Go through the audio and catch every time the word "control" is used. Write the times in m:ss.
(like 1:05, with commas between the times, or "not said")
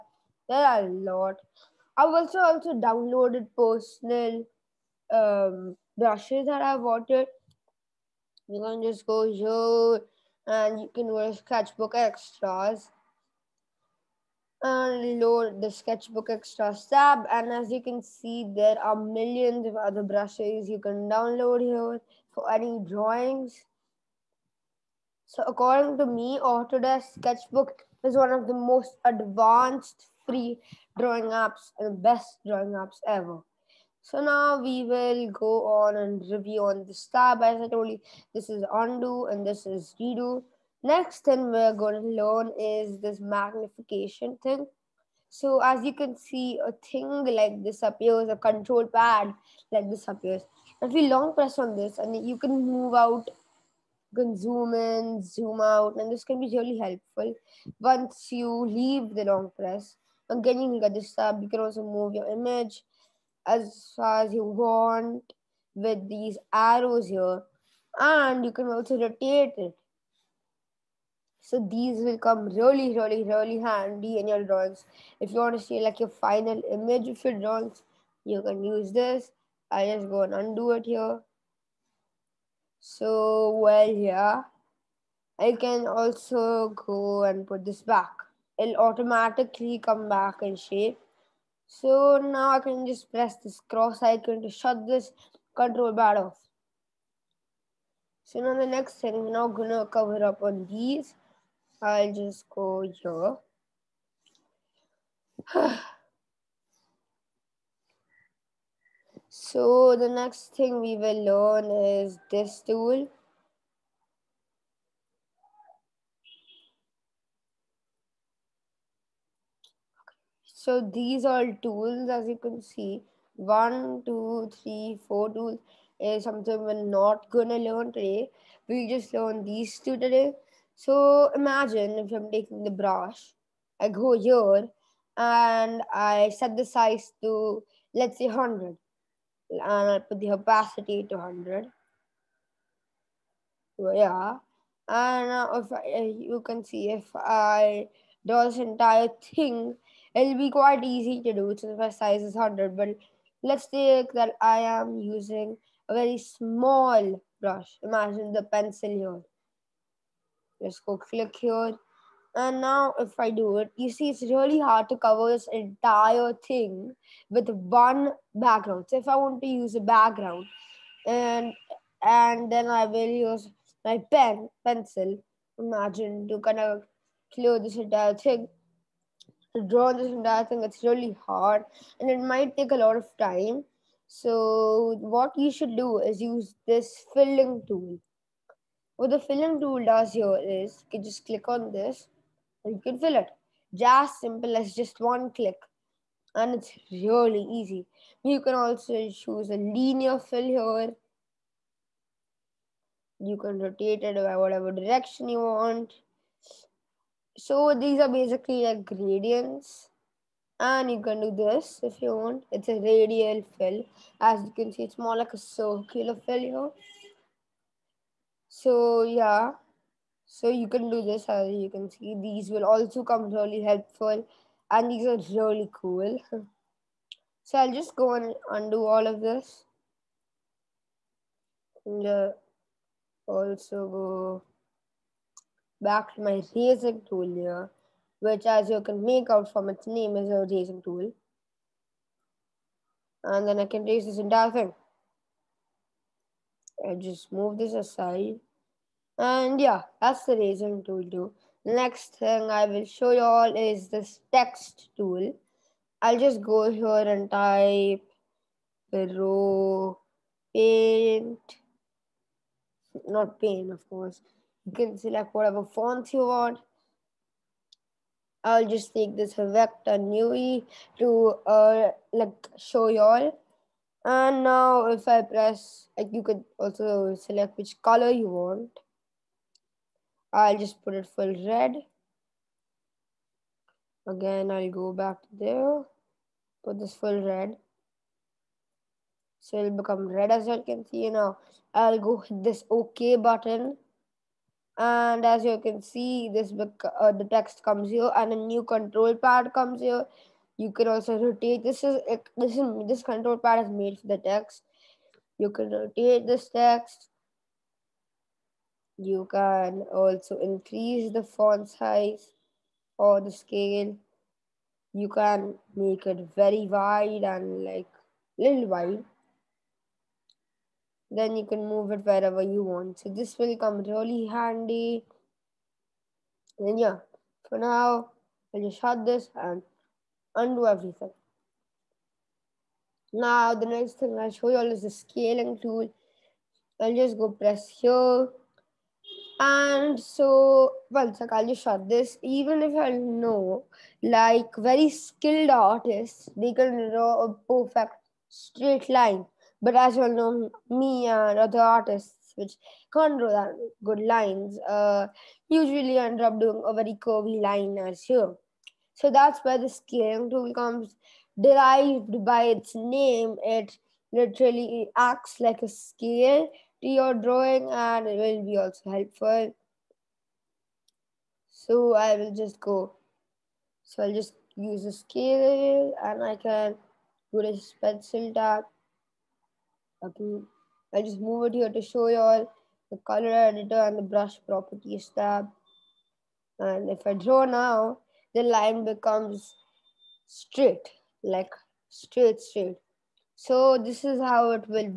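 0:48, 1:35, 4:58, 5:03.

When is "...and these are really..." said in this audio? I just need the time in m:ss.
3:44.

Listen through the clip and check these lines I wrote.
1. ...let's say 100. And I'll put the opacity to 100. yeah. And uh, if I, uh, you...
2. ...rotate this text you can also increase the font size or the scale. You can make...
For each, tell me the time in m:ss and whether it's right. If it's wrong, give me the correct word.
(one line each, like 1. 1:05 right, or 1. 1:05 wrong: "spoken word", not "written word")
1. 2:17 right
2. 5:05 right.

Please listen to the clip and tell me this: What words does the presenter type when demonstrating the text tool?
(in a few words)
pro paint.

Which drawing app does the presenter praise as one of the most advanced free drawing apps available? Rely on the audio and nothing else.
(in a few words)
Autodesk Sketchbook.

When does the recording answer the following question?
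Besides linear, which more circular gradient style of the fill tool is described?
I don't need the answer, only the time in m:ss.
3:32.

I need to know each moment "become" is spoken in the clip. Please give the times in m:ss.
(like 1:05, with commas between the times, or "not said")
4:49, 6:28.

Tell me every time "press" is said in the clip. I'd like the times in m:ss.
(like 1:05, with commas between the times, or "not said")
0:51, 0:59, 1:33, 4:35, 5:37.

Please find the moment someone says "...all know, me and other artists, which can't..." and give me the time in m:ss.
5:50.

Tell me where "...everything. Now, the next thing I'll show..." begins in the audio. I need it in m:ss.
5:30.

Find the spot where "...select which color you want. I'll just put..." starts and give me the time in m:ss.
4:37.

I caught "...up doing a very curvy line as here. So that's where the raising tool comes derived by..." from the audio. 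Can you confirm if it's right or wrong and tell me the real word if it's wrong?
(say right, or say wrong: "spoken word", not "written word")
wrong: "scaling", not "raising".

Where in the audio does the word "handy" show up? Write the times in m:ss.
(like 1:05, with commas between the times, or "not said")
1:13, 5:24.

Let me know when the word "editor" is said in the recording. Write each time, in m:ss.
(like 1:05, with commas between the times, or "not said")
6:23.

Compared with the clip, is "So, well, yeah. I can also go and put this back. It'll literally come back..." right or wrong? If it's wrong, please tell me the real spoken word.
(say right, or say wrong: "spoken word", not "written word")
wrong: "automatically", not "literally".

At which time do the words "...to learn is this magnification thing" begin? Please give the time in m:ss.
0:41.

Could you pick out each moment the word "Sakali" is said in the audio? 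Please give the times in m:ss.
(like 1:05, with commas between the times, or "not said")
5:41.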